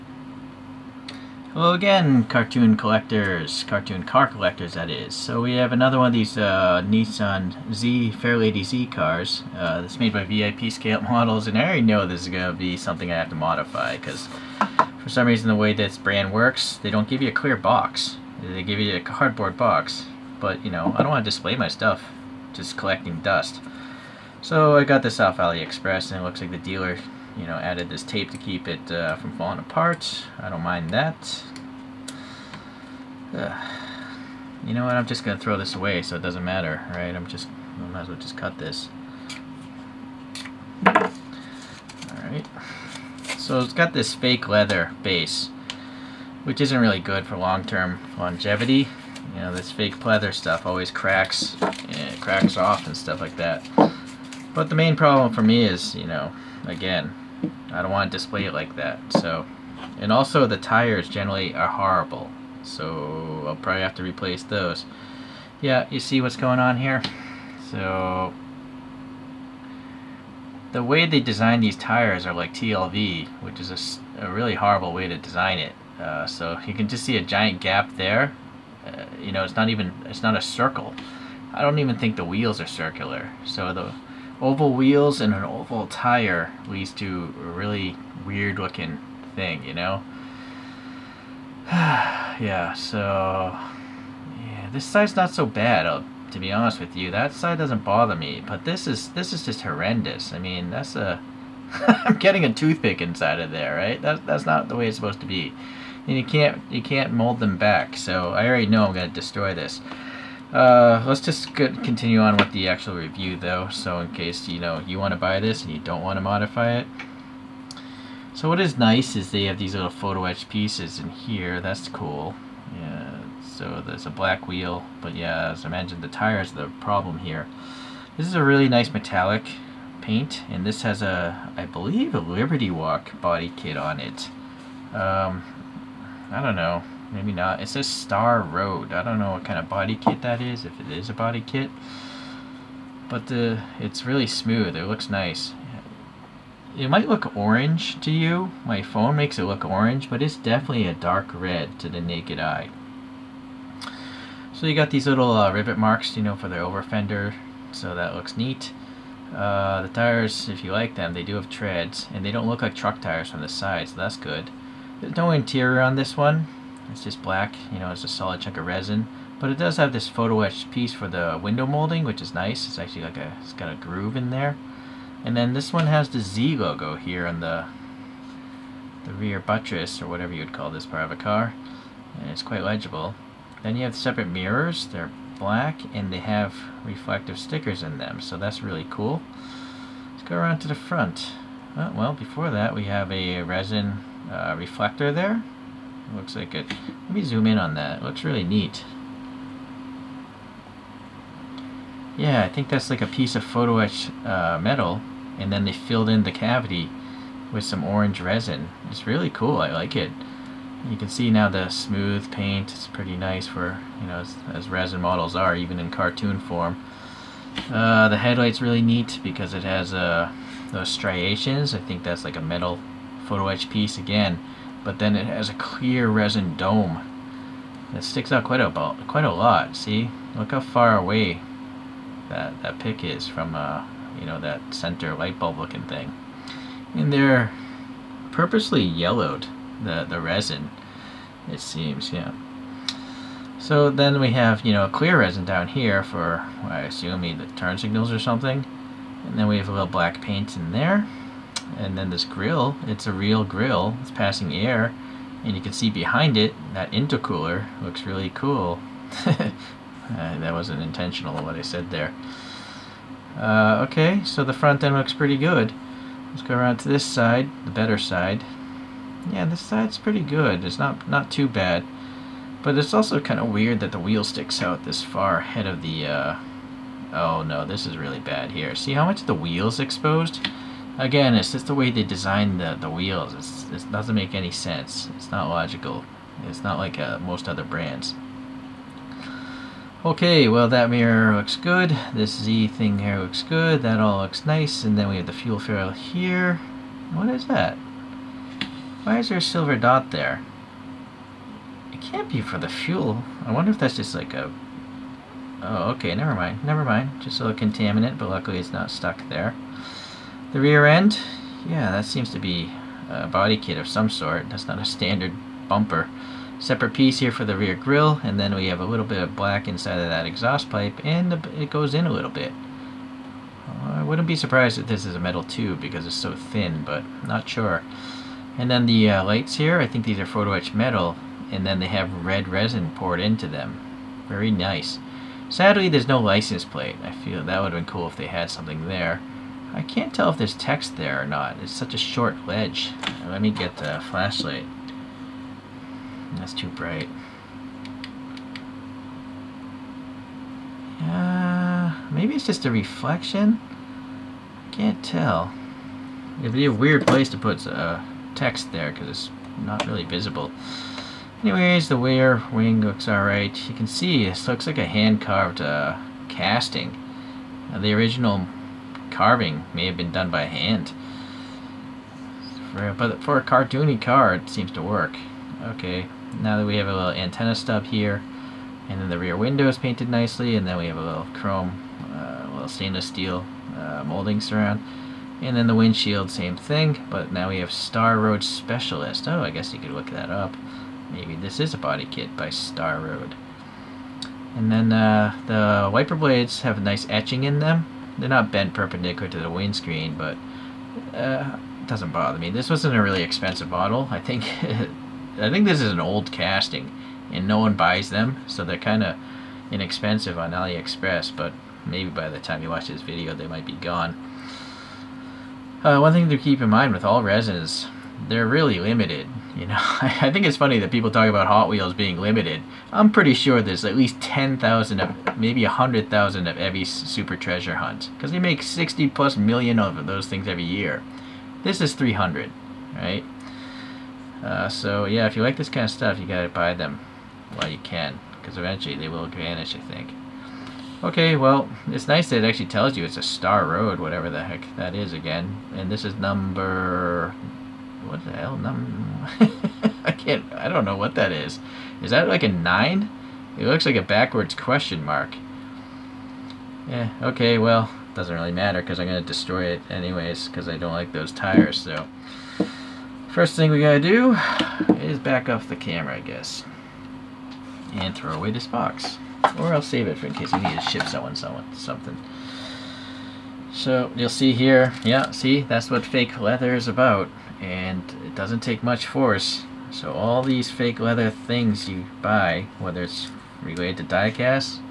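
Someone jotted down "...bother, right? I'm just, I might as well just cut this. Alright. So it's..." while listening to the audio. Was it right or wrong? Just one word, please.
wrong.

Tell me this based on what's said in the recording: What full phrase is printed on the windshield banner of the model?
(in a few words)
Star Road Specialist.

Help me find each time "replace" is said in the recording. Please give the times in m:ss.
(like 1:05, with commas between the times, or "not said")
1:04.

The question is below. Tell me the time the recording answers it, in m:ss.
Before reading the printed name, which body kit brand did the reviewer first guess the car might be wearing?
2:12.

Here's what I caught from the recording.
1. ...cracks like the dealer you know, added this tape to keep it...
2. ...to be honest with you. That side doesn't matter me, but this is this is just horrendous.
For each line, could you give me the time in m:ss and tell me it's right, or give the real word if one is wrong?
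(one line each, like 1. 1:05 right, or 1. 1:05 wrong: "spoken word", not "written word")
1. 0:26 wrong: "looks", not "cracks"
2. 1:36 wrong: "bother", not "matter".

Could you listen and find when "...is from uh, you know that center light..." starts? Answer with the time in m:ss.
3:53.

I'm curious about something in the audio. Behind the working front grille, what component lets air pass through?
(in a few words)
Intercooler.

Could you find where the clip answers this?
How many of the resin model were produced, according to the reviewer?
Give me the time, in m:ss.
7:11.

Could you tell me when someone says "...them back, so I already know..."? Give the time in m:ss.
1:47.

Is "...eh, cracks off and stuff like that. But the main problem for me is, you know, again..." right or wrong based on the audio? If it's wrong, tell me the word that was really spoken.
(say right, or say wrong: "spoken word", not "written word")
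right.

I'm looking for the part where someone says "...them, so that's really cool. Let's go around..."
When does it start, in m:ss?
3:07.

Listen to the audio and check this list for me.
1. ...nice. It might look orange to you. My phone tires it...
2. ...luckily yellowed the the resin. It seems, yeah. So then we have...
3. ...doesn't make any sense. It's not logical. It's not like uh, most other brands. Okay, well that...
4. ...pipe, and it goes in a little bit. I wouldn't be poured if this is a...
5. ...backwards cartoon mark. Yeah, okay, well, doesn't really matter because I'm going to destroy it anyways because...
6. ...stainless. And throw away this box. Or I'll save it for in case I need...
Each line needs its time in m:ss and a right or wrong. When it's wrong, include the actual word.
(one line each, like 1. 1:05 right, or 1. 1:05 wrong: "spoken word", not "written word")
1. 2:25 wrong: "makes", not "tires"
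2. 3:58 wrong: "purposely", not "luckily"
3. 4:43 right
4. 5:20 wrong: "surprised", not "poured"
5. 7:34 wrong: "question", not "cartoon"
6. 7:46 wrong: "guess", not "stainless".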